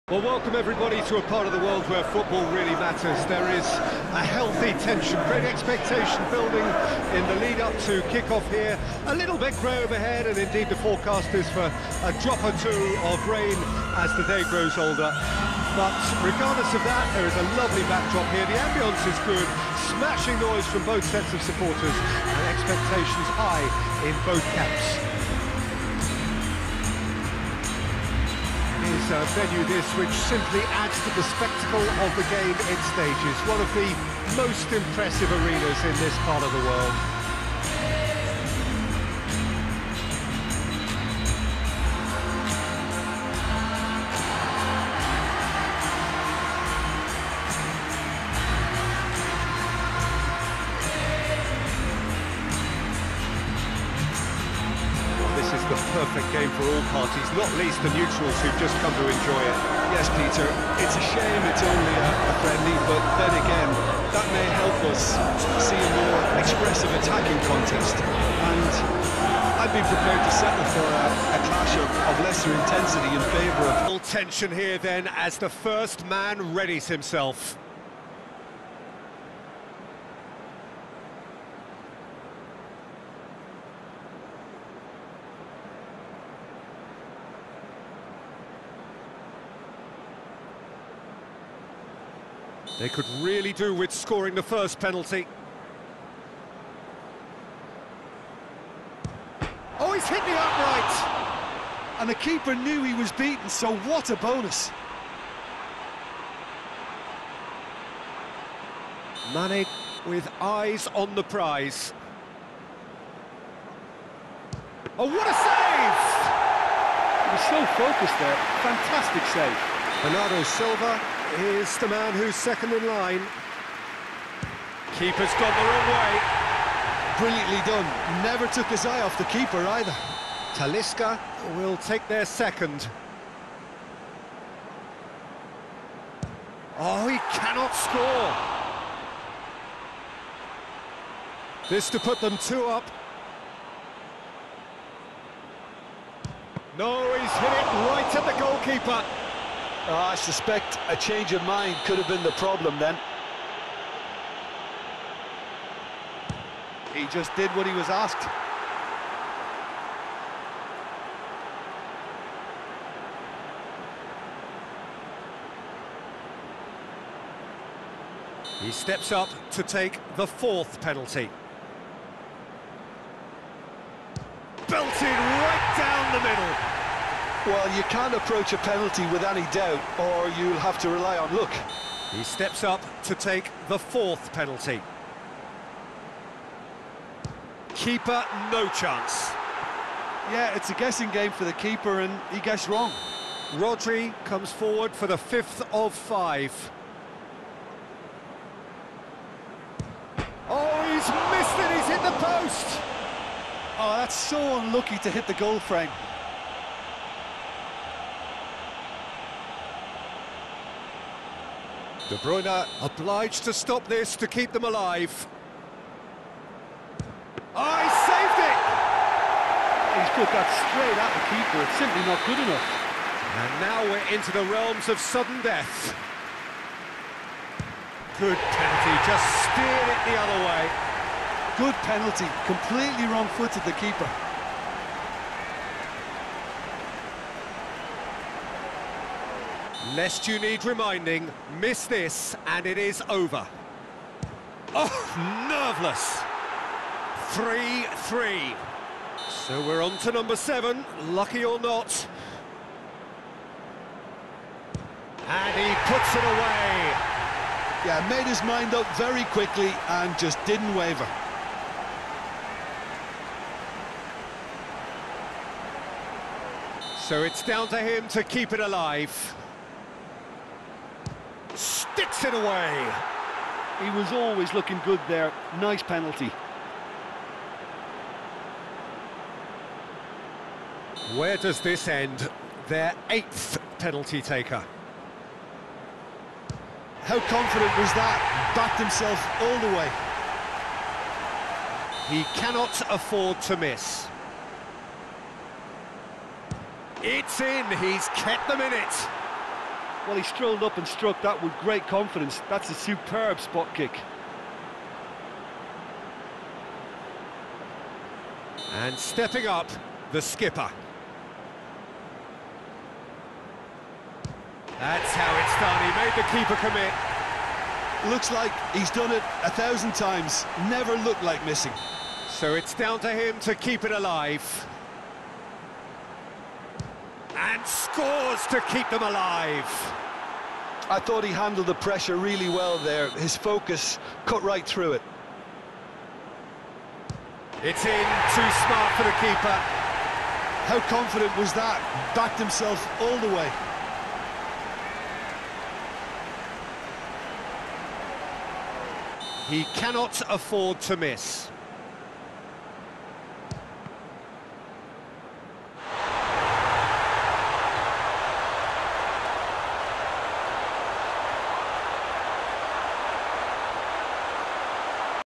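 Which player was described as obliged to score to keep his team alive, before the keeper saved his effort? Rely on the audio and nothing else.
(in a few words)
De Bruyne.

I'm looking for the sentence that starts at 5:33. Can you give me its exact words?
His focus cut right through it.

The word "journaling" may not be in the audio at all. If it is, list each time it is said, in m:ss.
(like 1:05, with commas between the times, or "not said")
not said.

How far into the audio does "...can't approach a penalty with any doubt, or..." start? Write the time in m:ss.
2:57.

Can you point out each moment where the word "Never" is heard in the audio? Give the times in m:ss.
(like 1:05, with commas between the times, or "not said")
2:08, 5:20.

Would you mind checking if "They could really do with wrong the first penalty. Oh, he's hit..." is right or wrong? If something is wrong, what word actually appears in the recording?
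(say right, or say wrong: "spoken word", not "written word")
wrong: "scoring", not "wrong".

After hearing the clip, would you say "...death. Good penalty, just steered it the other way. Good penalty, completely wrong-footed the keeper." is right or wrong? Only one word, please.
right.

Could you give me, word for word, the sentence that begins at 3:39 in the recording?
He's put that straight at the keeper, it's simply not good enough.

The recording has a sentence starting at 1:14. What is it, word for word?
Tension here then as the first man readies himself.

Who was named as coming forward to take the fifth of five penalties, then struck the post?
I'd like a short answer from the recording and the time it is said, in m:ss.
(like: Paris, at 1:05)
Rodri, at 3:13.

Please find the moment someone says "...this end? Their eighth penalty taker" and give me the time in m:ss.
4:41.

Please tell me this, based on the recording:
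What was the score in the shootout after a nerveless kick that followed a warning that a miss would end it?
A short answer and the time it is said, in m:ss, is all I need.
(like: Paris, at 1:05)
3-3, at 4:07.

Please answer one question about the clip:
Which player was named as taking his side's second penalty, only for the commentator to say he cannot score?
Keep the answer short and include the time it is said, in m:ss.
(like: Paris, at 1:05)
Talisca, at 2:10.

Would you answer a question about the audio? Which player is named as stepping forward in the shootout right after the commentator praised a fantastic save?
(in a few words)
Bernardo Silva.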